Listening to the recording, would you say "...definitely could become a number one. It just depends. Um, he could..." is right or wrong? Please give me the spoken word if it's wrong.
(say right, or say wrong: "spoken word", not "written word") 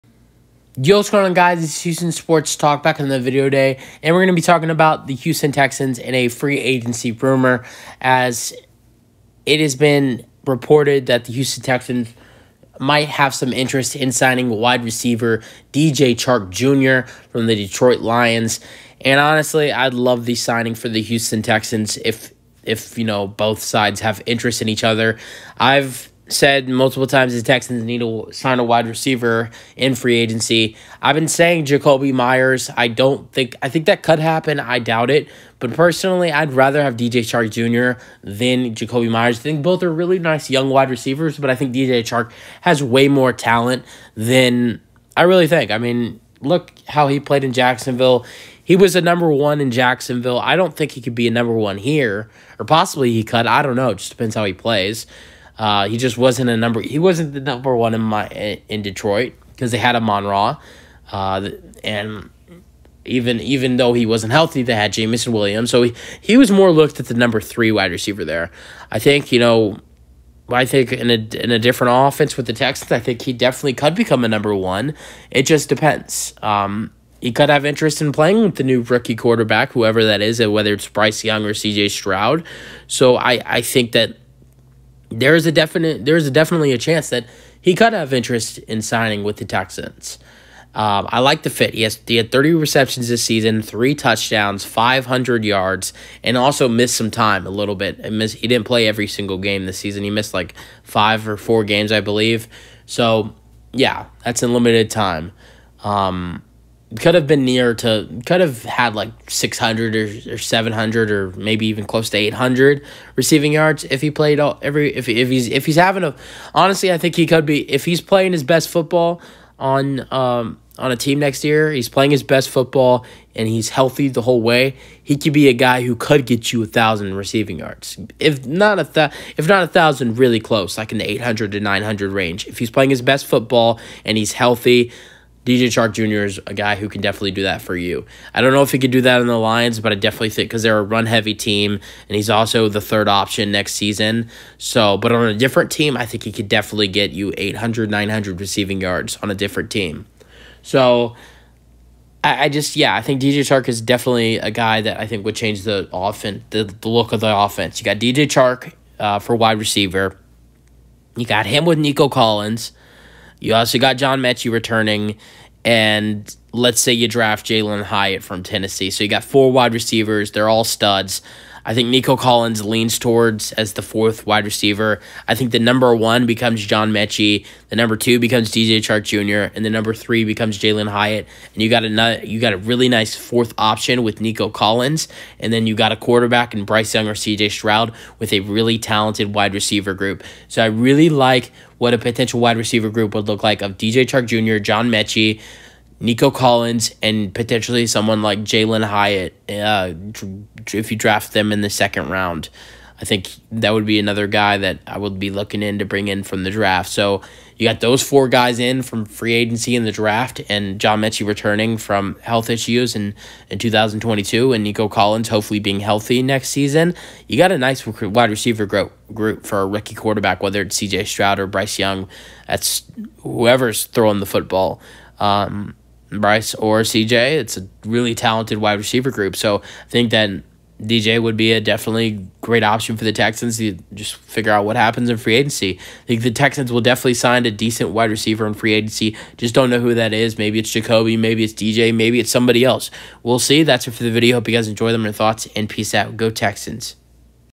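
right.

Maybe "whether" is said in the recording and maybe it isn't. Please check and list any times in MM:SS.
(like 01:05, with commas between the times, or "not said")
01:20, 03:40.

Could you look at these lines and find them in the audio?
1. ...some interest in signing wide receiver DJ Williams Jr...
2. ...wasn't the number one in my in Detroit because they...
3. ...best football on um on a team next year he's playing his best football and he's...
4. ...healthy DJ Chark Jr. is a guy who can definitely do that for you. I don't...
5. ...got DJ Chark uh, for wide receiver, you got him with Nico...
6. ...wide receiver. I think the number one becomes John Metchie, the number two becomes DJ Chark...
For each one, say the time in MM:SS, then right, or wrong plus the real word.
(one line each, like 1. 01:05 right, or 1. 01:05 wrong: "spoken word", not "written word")
1. 00:13 wrong: "Chark", not "Williams"
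2. 00:56 right
3. 01:58 right
4. 02:14 right
5. 02:37 right
6. 02:54 right.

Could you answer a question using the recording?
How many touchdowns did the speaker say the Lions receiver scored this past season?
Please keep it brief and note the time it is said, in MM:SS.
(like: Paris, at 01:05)
3, at 01:33.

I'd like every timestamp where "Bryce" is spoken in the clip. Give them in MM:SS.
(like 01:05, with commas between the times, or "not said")
01:20, 03:06, 03:41, 03:46.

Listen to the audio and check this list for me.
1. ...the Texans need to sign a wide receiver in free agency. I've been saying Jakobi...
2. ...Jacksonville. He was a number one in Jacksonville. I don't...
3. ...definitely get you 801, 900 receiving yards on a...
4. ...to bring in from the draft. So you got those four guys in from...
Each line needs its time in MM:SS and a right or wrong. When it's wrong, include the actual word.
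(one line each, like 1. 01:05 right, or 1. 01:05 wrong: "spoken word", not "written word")
1. 00:27 right
2. 00:47 right
3. 02:26 wrong: "800", not "801"
4. 03:25 right.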